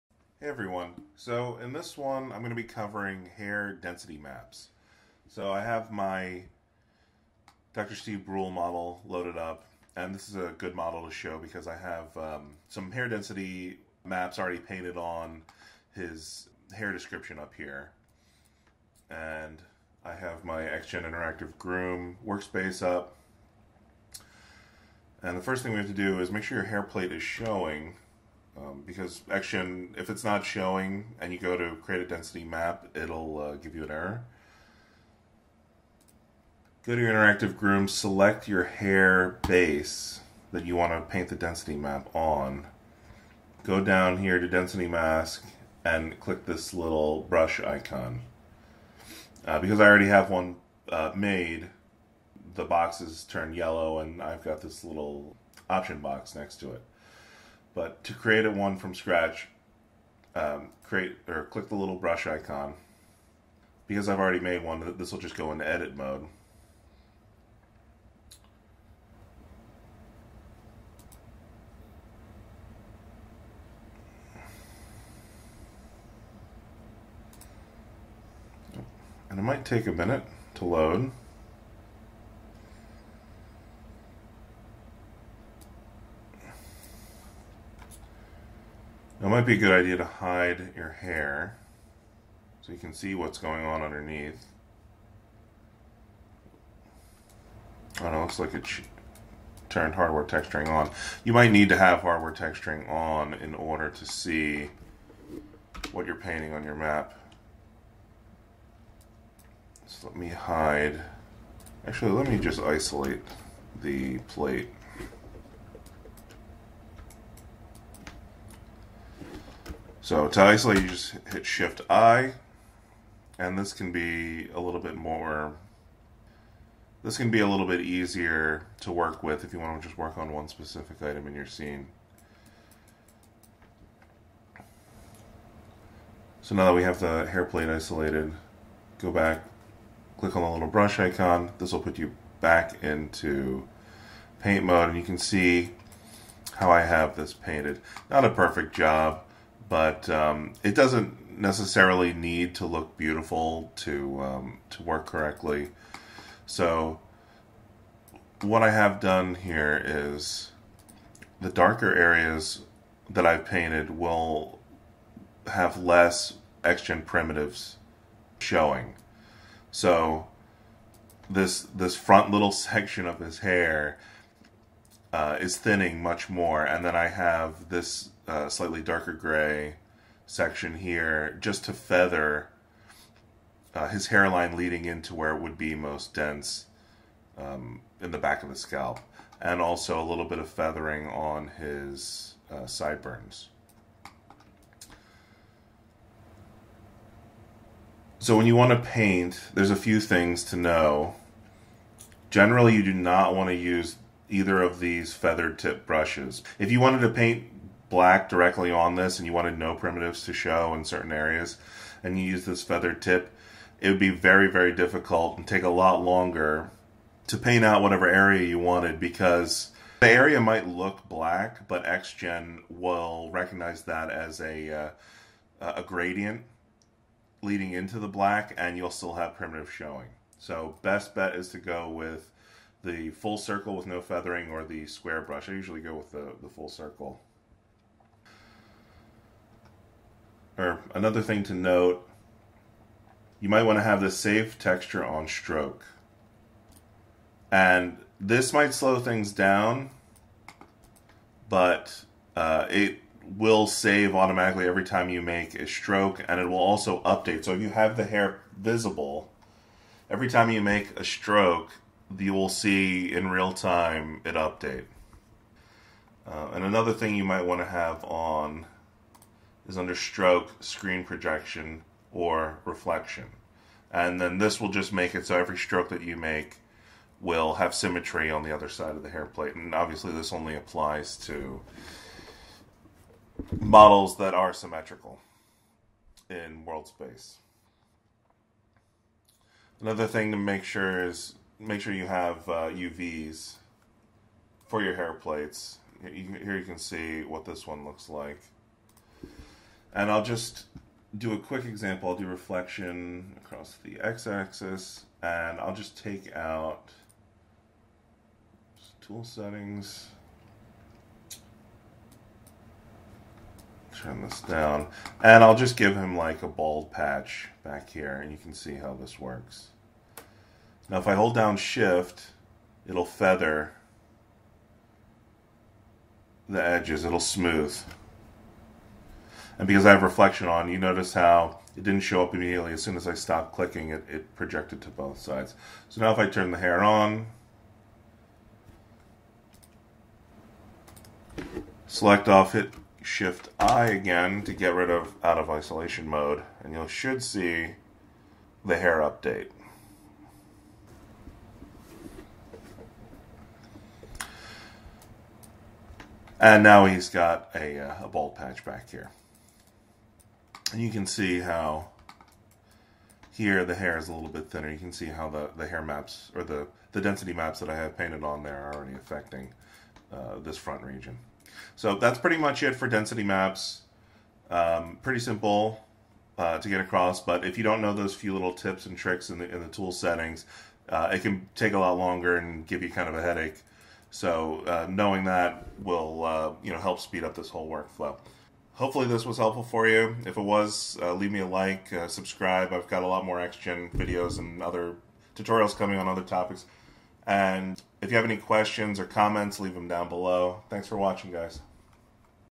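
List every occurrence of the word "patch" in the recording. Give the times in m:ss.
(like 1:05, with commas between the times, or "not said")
5:16, 5:58.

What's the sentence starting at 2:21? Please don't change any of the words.
This will put you back into paint mode and you can see how I have this painted.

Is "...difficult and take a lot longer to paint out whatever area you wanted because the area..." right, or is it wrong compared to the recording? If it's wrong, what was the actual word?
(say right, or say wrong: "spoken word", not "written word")
right.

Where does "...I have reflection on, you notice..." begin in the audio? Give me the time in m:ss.
5:29.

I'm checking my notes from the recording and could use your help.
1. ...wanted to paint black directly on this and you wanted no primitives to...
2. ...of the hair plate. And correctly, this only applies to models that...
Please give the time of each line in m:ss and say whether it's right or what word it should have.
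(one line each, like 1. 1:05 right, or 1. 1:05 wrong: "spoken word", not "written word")
1. 3:26 right
2. 4:38 wrong: "obviously", not "correctly".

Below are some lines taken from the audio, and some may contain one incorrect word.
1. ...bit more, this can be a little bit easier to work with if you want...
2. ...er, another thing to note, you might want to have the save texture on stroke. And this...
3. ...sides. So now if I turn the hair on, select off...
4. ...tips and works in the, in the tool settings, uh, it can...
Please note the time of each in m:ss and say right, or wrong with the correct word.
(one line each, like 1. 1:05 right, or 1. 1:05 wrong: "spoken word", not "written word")
1. 2:04 right
2. 4:00 right
3. 5:35 right
4. 6:18 wrong: "tricks", not "works".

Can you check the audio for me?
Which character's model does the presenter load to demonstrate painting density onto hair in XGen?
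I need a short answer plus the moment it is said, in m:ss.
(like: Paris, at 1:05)
Dr. Steve Brule, at 0:07.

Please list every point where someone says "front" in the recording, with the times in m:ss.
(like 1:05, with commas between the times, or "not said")
2:51, 6:10.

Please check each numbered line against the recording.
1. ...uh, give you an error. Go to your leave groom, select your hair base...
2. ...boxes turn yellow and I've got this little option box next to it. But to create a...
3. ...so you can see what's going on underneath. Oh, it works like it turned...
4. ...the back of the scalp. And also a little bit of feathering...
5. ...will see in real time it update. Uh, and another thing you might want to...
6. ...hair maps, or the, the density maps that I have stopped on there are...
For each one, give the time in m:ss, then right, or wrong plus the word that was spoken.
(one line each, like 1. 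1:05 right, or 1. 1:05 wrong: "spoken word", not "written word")
1. 0:33 wrong: "interactive", not "leave"
2. 0:52 right
3. 1:32 wrong: "looks", not "works"
4. 3:08 right
5. 4:22 right
6. 6:05 wrong: "painted", not "stopped".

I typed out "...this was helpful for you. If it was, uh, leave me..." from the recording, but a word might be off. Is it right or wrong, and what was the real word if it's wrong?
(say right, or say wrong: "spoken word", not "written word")
right.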